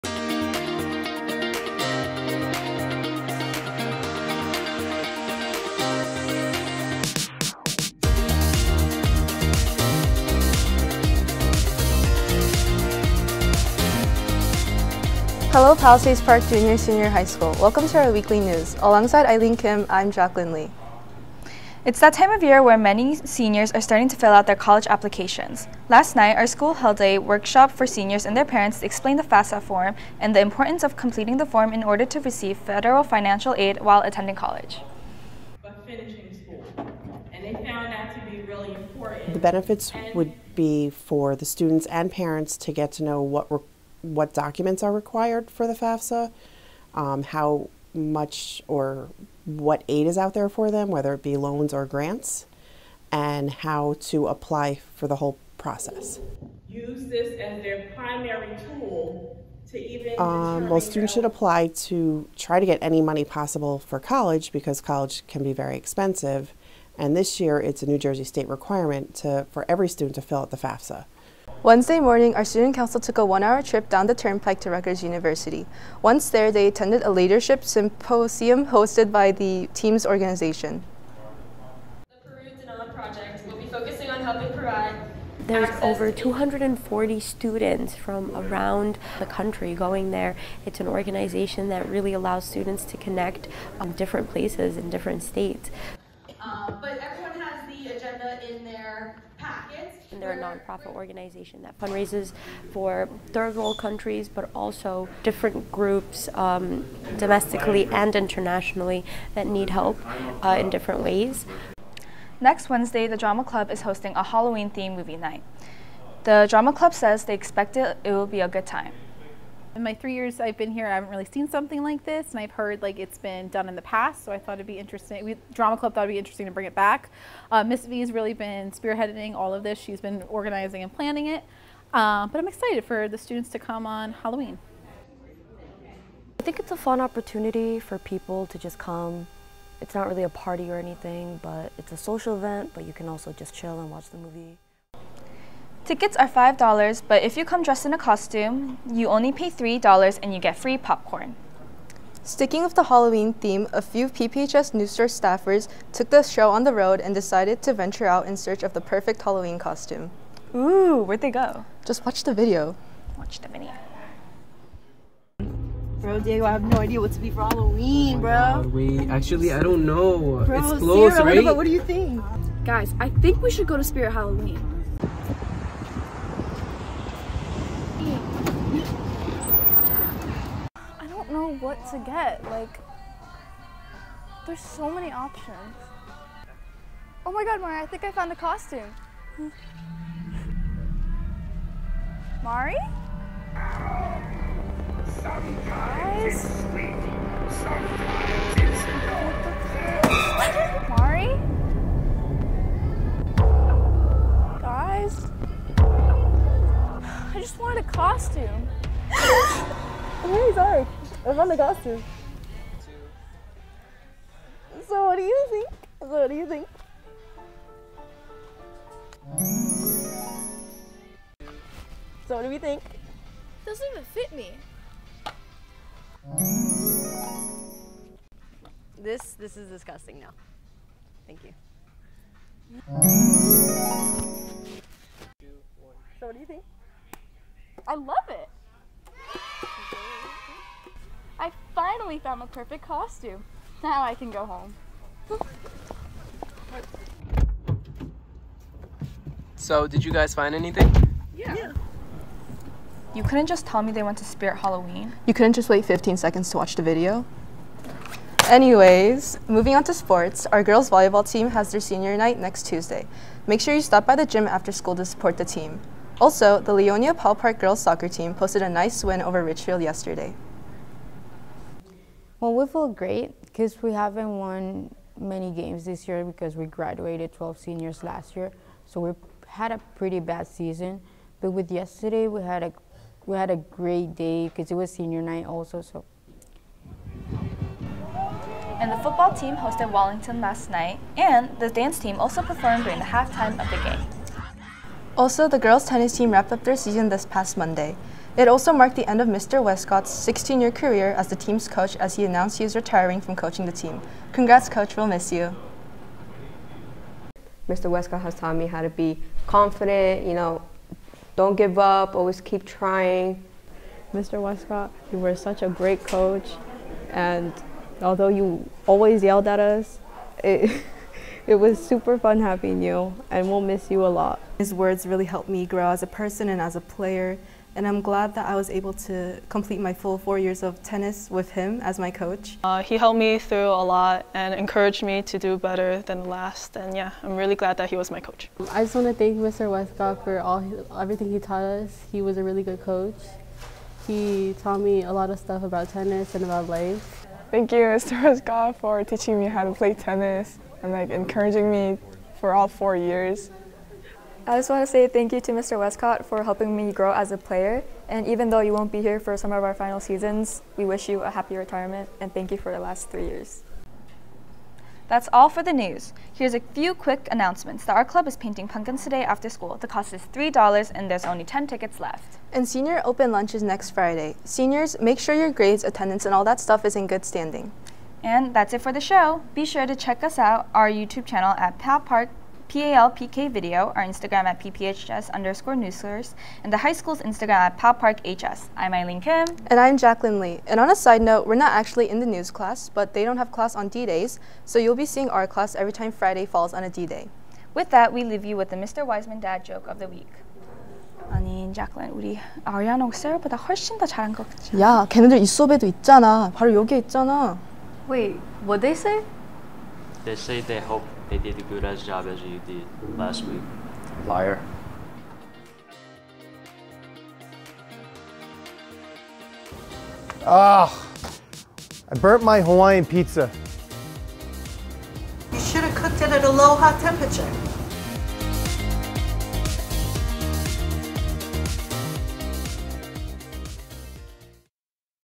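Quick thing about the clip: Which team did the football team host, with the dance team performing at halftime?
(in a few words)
Wallington.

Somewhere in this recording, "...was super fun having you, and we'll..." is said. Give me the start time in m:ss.
5:21.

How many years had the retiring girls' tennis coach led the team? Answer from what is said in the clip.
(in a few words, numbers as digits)
16.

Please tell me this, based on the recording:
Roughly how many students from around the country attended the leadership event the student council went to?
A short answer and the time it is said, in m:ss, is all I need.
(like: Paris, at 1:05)
240, at 1:26.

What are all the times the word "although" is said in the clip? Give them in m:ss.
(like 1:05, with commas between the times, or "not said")
5:18.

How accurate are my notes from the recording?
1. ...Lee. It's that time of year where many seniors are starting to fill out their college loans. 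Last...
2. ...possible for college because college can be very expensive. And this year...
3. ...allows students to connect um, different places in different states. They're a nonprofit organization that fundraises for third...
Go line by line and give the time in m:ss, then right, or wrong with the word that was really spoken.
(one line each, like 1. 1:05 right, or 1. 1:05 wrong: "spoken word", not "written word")
1. 0:20 wrong: "applications", not "loans"
2. 1:03 right
3. 1:32 right.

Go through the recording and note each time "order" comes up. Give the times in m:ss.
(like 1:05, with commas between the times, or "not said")
0:31.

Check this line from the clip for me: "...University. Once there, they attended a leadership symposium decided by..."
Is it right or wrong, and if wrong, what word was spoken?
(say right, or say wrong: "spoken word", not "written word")
wrong: "hosted", not "decided".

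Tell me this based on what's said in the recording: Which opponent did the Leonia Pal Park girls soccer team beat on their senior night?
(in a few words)
Ridgefield.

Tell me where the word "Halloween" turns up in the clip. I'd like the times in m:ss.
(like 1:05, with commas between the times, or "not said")
1:54, 2:14, 2:32, 2:39, 2:47, 2:54, 4:14.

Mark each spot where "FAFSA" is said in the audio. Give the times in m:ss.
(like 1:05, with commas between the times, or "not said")
0:29, 0:45, 1:10.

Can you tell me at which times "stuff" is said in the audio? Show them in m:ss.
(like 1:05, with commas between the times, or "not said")
5:45, 6:16.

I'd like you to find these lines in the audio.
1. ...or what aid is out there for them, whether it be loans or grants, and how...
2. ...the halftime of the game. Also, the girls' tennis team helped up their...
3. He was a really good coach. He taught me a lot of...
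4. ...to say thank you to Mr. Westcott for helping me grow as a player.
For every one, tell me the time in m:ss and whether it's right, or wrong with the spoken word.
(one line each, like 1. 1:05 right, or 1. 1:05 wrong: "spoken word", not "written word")
1. 0:48 right
2. 4:52 wrong: "wrapped", not "helped"
3. 5:42 right
4. 5:54 right.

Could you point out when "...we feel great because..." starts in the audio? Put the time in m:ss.
4:32.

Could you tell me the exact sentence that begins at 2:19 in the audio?
It's not really a party or anything, but it's a social event, but you can also just chill and watch the movie.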